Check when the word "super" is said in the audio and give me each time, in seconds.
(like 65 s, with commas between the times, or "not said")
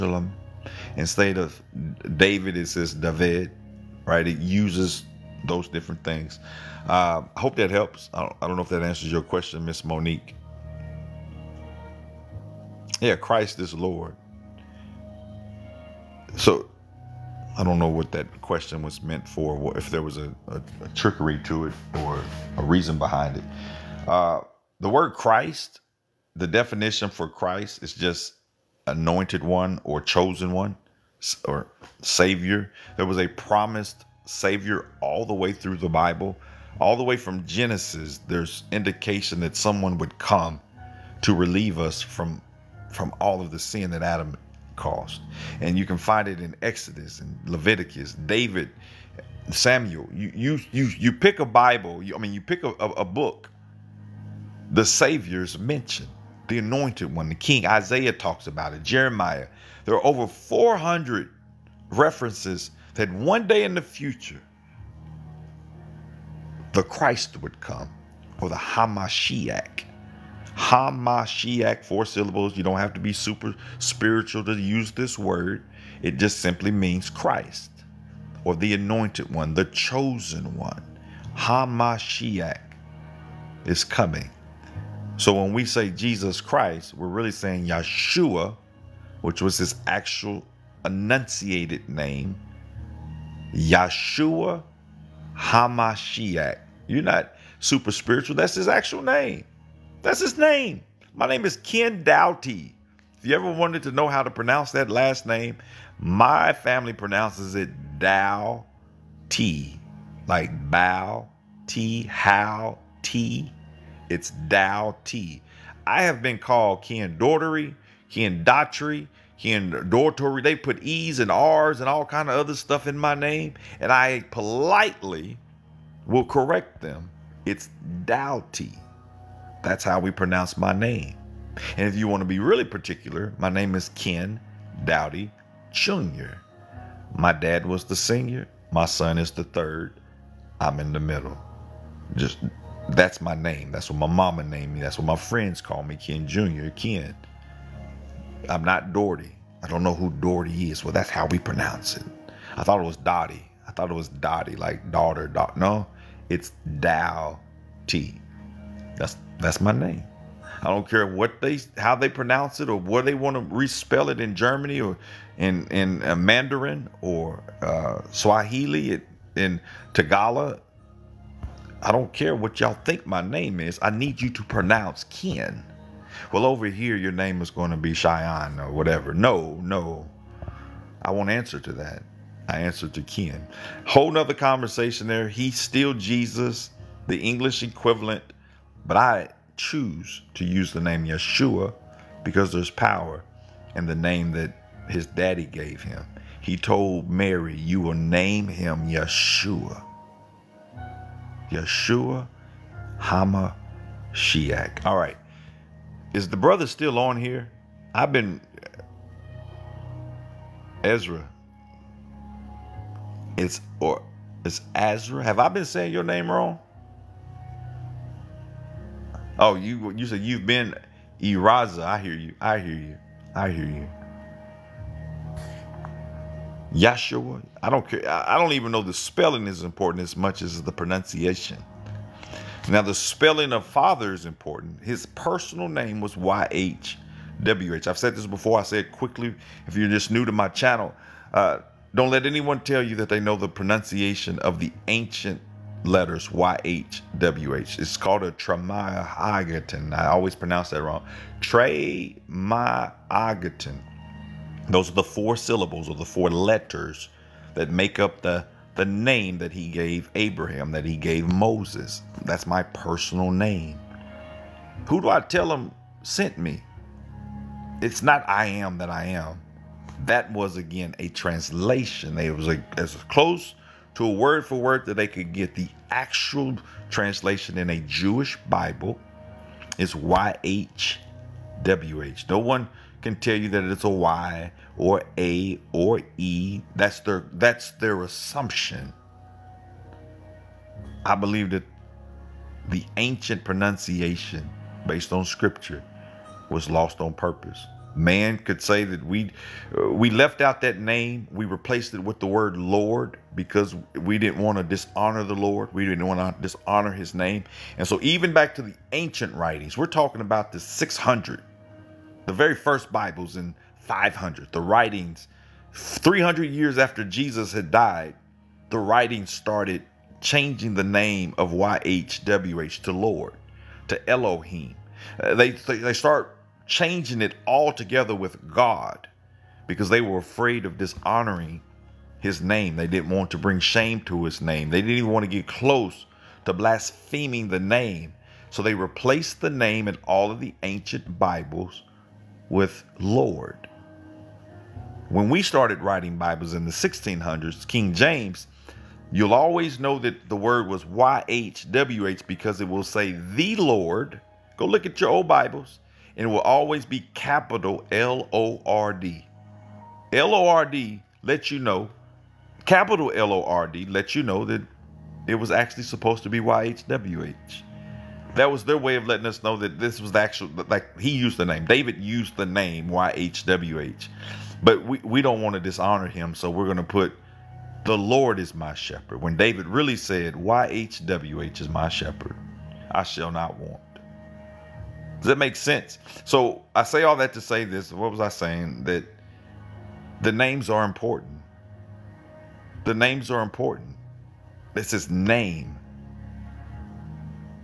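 73 s, 97 s.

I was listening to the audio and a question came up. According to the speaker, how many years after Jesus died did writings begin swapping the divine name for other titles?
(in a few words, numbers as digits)
300 years.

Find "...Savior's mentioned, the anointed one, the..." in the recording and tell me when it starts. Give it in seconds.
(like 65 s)
54 s.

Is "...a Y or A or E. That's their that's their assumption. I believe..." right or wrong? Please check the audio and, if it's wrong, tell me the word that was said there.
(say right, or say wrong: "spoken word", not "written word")
right.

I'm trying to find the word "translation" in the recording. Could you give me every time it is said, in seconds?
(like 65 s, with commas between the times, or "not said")
271 s, 276 s.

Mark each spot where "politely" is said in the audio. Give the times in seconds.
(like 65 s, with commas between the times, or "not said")
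124 s.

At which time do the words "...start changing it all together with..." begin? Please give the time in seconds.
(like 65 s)
325 s.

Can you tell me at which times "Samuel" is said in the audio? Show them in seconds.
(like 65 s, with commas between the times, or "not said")
49 s.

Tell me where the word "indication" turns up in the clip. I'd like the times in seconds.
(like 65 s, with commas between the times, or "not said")
38 s.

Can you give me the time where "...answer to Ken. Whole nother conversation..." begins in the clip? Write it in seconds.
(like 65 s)
182 s.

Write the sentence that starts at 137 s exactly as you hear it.
My dad was the senior, my son is the third, I'm in the middle.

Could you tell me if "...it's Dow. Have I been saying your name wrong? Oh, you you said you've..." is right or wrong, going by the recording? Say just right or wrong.
wrong.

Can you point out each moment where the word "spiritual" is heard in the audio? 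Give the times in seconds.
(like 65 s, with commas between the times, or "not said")
73 s, 97 s.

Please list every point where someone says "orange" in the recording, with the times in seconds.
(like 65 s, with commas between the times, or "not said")
not said.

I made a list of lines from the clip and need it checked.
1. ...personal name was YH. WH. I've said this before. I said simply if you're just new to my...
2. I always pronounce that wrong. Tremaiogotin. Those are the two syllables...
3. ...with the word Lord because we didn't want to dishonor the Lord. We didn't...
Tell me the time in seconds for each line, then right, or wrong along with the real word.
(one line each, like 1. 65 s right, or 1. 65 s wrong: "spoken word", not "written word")
1. 235 s wrong: "quickly", not "simply"
2. 249 s wrong: "four", not "two"
3. 301 s right.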